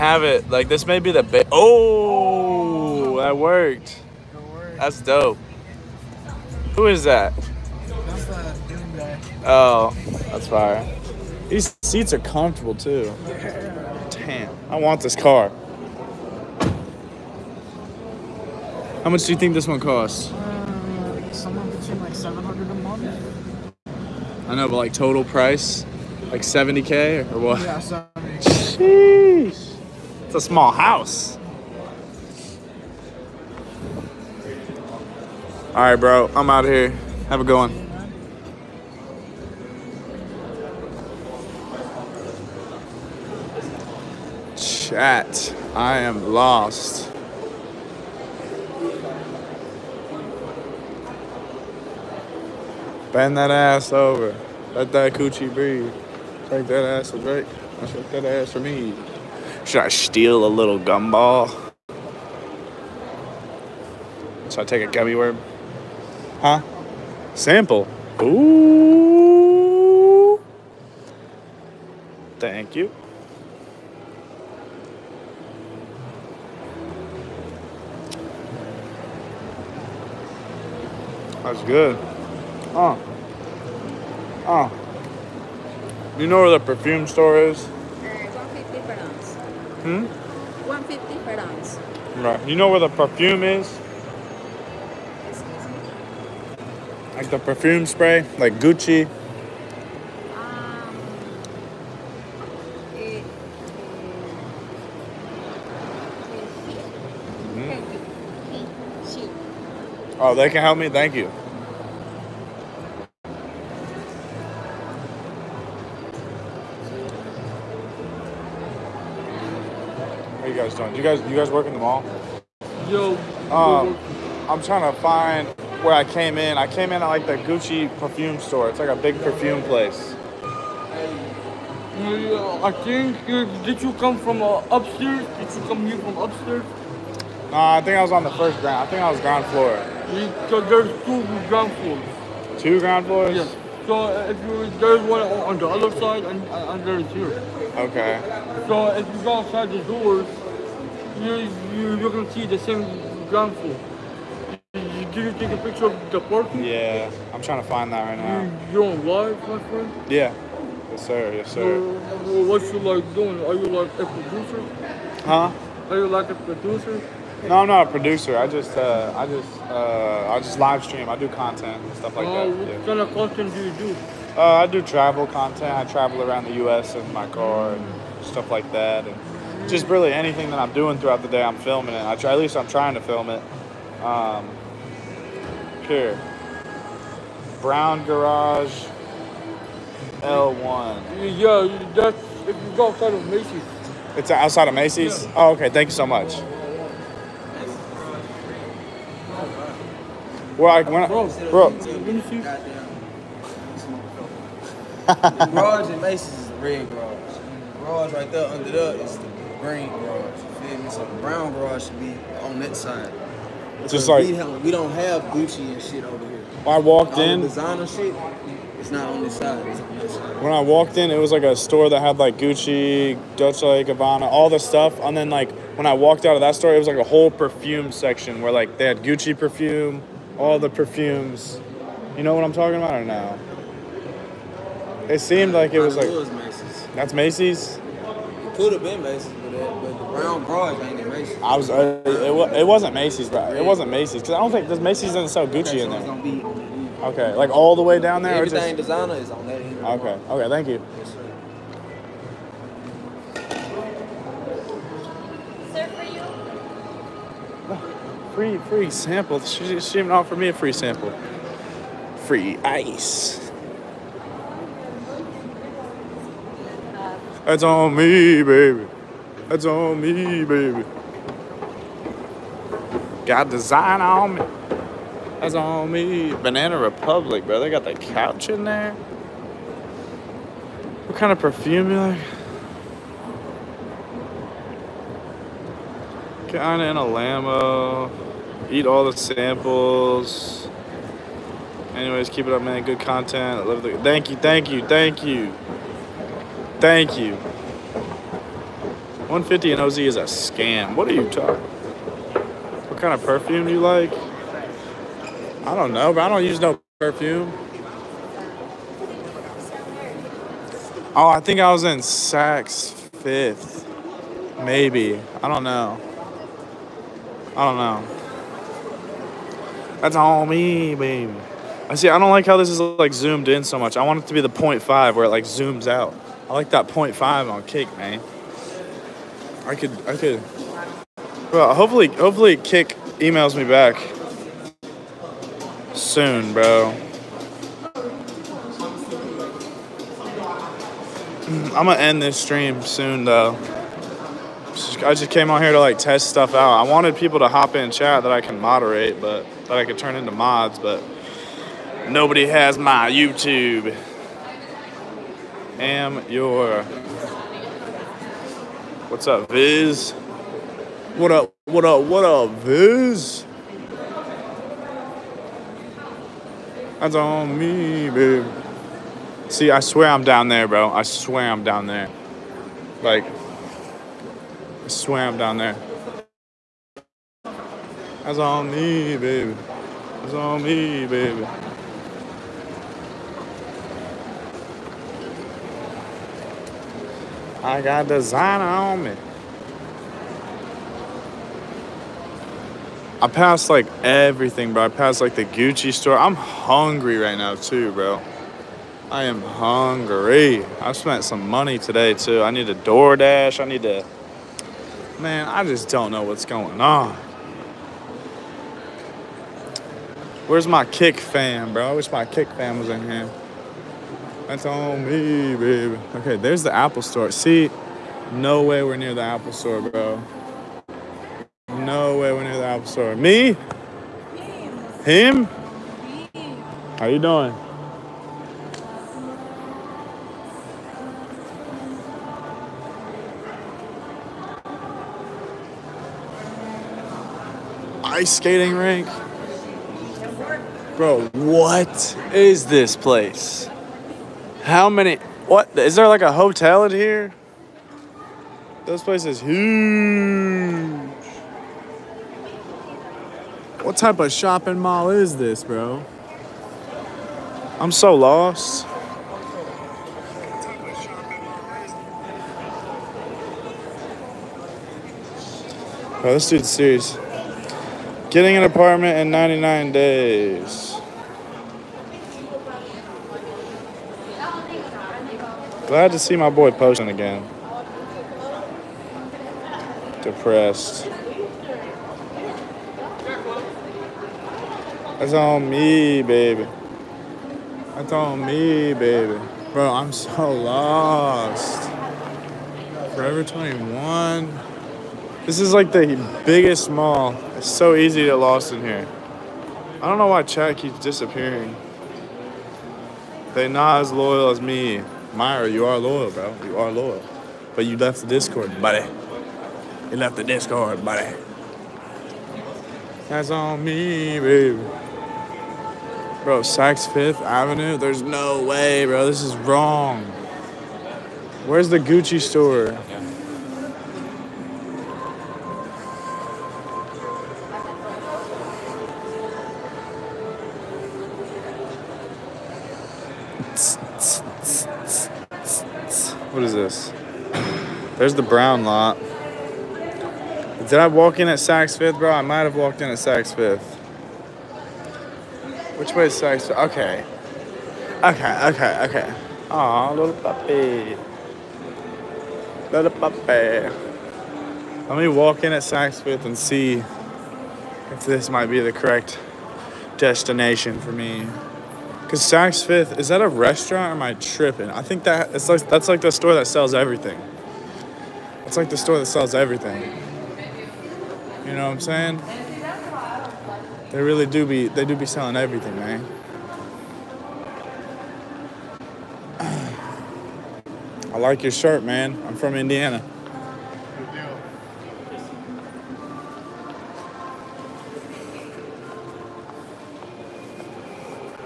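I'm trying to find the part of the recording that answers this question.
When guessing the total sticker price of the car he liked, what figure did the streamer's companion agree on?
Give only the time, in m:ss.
0:26.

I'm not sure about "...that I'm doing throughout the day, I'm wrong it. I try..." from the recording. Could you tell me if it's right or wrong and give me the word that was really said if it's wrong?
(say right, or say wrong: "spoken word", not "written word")
wrong: "filming", not "wrong".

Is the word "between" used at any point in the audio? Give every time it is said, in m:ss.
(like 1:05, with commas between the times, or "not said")
0:21.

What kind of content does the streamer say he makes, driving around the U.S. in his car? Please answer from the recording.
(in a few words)
Travel content.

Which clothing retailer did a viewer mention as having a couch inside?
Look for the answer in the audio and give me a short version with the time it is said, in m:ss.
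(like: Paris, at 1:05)
Banana Republic, at 4:36.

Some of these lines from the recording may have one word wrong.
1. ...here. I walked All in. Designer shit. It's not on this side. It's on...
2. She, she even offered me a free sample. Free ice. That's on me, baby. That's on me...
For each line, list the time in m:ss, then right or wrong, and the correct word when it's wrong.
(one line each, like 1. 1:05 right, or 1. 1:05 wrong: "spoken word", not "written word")
1. 3:36 right
2. 4:19 right.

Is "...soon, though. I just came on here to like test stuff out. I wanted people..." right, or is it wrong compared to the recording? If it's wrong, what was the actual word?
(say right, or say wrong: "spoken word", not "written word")
right.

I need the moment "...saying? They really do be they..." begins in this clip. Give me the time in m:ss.
9:31.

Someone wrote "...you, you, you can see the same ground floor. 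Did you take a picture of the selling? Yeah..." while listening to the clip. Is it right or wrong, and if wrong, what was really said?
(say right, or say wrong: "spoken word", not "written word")
wrong: "parking", not "selling".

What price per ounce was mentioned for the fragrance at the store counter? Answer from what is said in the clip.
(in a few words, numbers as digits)
150.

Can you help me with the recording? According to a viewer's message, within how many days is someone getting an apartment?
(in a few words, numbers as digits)
99 days.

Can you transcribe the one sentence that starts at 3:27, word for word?
The garage right there under there is the green garage.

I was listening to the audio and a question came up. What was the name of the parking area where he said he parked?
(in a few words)
Brown Garage L1.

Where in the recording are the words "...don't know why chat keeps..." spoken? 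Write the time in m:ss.
8:20.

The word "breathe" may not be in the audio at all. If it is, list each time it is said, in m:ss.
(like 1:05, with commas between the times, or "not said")
0:55.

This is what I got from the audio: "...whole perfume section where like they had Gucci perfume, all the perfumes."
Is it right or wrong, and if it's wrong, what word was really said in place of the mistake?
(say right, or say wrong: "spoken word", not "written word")
right.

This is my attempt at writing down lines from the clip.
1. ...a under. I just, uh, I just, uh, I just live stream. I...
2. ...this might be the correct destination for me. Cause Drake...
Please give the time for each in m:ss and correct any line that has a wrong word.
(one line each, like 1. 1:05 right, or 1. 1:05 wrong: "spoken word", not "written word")
1. 2:47 wrong: "producer", not "under"
2. 9:18 wrong: "Saks", not "Drake".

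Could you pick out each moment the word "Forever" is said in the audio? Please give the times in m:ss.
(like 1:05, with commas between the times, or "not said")
8:13.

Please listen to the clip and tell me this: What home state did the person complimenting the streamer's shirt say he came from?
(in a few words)
Indiana.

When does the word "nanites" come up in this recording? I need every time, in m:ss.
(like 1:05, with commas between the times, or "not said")
not said.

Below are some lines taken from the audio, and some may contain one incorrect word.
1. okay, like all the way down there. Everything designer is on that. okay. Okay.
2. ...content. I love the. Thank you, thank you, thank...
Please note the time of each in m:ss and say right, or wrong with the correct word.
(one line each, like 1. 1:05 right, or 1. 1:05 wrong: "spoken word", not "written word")
1. 4:07 right
2. 4:52 right.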